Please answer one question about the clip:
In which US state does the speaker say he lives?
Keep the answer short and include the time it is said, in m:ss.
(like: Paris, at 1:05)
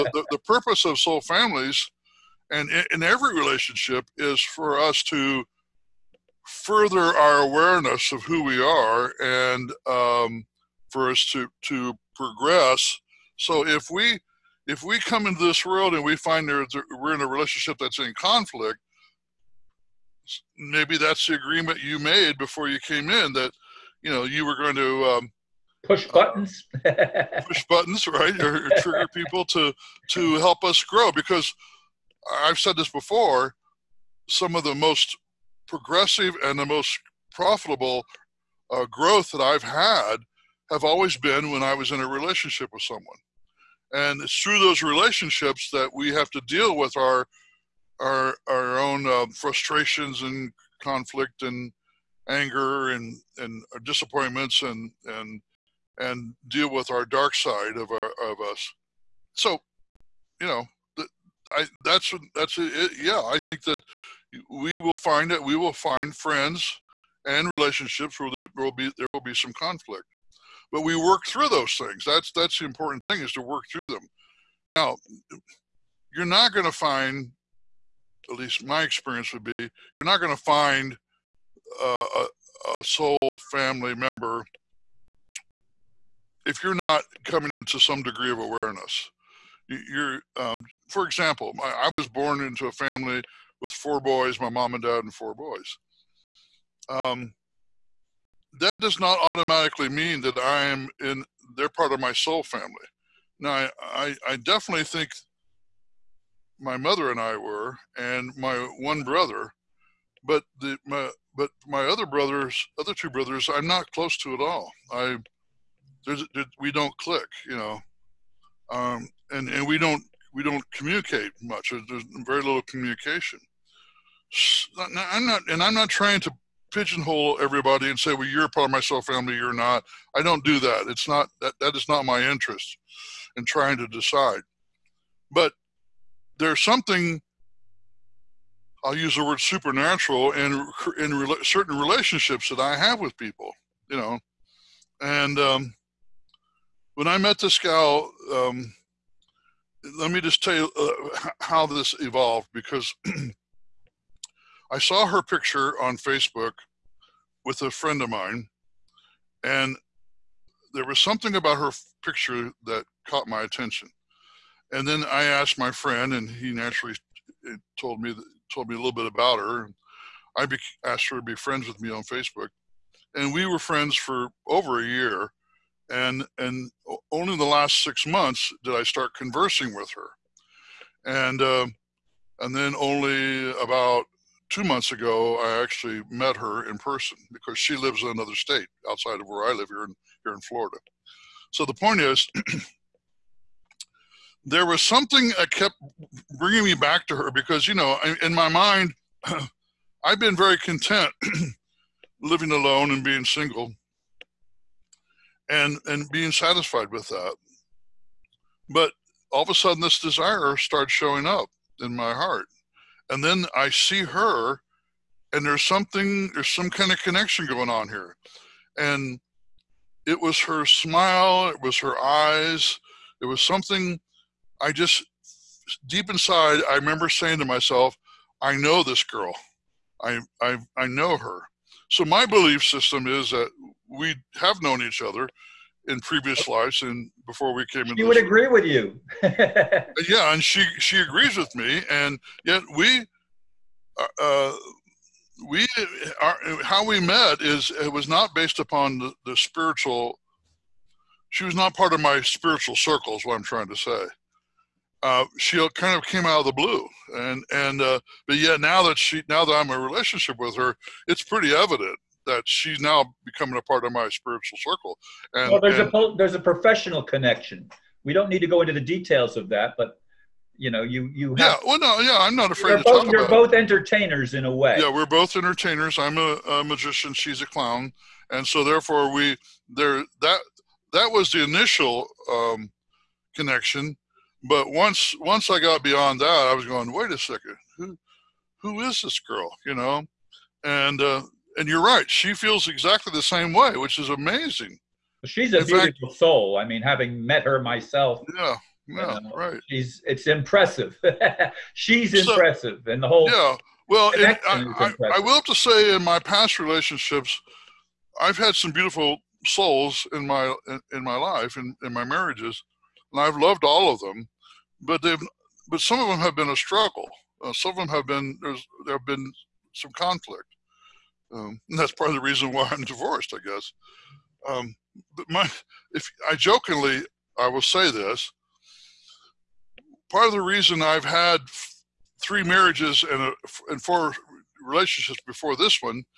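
Florida, at 3:10.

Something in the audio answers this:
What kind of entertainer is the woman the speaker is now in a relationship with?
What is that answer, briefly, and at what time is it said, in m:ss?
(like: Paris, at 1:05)
A clown, at 4:37.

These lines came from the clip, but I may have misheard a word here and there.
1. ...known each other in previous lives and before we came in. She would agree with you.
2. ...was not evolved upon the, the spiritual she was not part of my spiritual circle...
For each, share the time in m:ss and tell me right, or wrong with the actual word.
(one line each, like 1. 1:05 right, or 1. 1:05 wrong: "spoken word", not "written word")
1. 3:54 right
2. 4:07 wrong: "based", not "evolved".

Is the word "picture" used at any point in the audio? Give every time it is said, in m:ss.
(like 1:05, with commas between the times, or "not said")
2:35, 2:42.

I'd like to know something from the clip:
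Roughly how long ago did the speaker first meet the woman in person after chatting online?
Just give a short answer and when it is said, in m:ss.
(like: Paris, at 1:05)
about two months ago, at 3:03.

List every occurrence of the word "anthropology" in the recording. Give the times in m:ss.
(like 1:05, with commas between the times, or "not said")
not said.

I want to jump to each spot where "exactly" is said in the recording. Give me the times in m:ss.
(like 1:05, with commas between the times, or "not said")
4:52.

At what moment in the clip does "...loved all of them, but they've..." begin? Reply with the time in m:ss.
5:13.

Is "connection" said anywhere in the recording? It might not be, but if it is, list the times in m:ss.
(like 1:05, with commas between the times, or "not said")
3:37, 4:27, 4:43.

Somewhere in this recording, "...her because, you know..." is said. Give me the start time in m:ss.
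3:17.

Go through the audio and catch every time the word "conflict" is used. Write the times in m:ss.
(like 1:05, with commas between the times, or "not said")
0:18, 0:50, 1:09, 5:19.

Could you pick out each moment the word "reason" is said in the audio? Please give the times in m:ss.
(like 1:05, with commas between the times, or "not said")
5:22, 5:30.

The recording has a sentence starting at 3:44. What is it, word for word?
I just deep inside, I remember saying to myself, "I know this girl.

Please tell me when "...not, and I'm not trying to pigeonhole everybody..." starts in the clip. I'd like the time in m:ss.
2:05.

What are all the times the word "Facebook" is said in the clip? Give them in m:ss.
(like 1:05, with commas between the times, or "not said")
2:35, 2:52.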